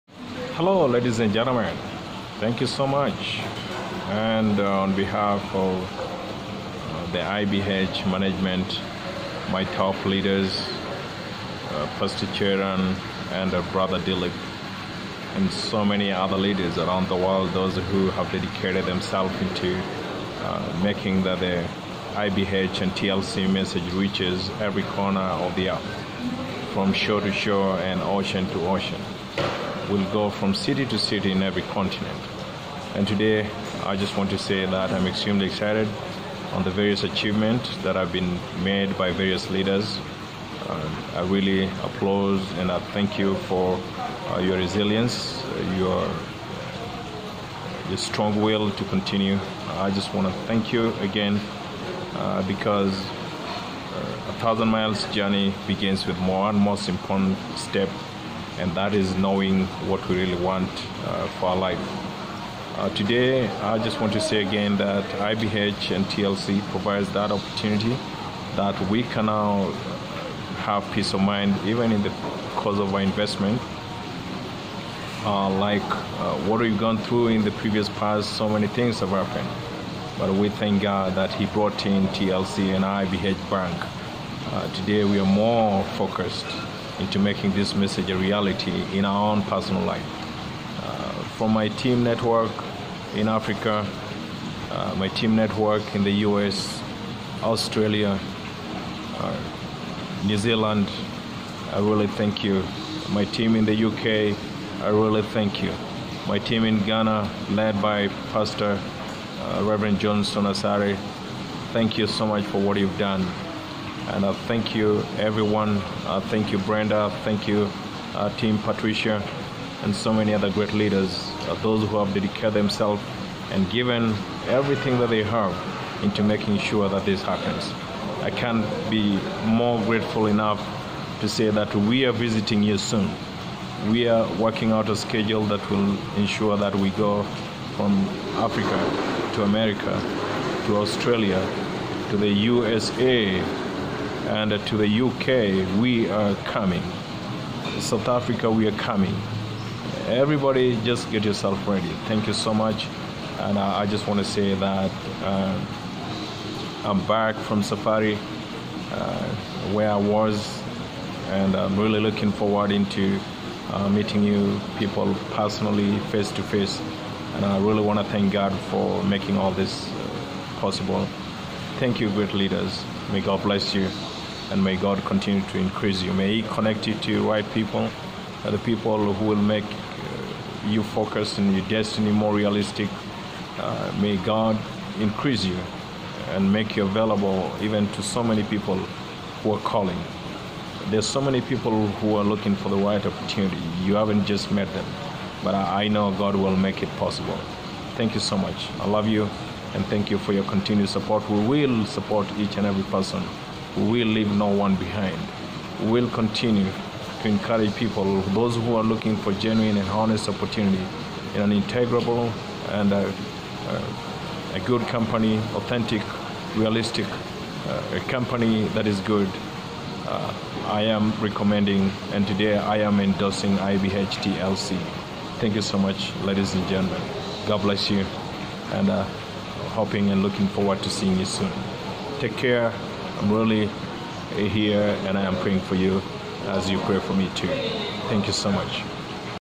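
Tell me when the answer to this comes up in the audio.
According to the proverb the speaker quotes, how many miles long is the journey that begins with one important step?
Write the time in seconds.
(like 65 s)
54 s.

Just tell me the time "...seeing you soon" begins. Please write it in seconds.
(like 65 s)
230 s.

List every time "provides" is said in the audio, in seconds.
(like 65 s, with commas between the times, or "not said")
66 s.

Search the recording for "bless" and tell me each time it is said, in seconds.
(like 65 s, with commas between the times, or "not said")
173 s, 227 s.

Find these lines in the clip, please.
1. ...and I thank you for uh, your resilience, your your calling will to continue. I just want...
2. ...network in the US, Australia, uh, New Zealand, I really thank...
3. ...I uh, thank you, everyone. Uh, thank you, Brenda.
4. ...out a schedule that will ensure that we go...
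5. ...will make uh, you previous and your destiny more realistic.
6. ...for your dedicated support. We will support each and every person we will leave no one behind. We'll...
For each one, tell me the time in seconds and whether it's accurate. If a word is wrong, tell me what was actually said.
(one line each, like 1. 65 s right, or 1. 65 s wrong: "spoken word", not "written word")
1. 42 s wrong: "strong", not "calling"
2. 95 s right
3. 114 s right
4. 134 s right
5. 179 s wrong: "focus", not "previous"
6. 200 s wrong: "continued", not "dedicated".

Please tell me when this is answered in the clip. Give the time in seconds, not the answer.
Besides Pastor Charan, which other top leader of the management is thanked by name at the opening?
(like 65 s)
13 s.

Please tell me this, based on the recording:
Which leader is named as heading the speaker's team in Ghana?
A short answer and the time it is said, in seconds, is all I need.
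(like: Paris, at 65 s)
Reverend John Asari, at 109 s.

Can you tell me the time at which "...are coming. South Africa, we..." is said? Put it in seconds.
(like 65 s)
146 s.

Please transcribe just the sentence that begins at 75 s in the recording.
Uh, like uh, what we've gone through in the previous past, so many things have happened.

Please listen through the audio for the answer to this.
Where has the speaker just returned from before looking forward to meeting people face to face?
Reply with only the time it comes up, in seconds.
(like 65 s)
157 s.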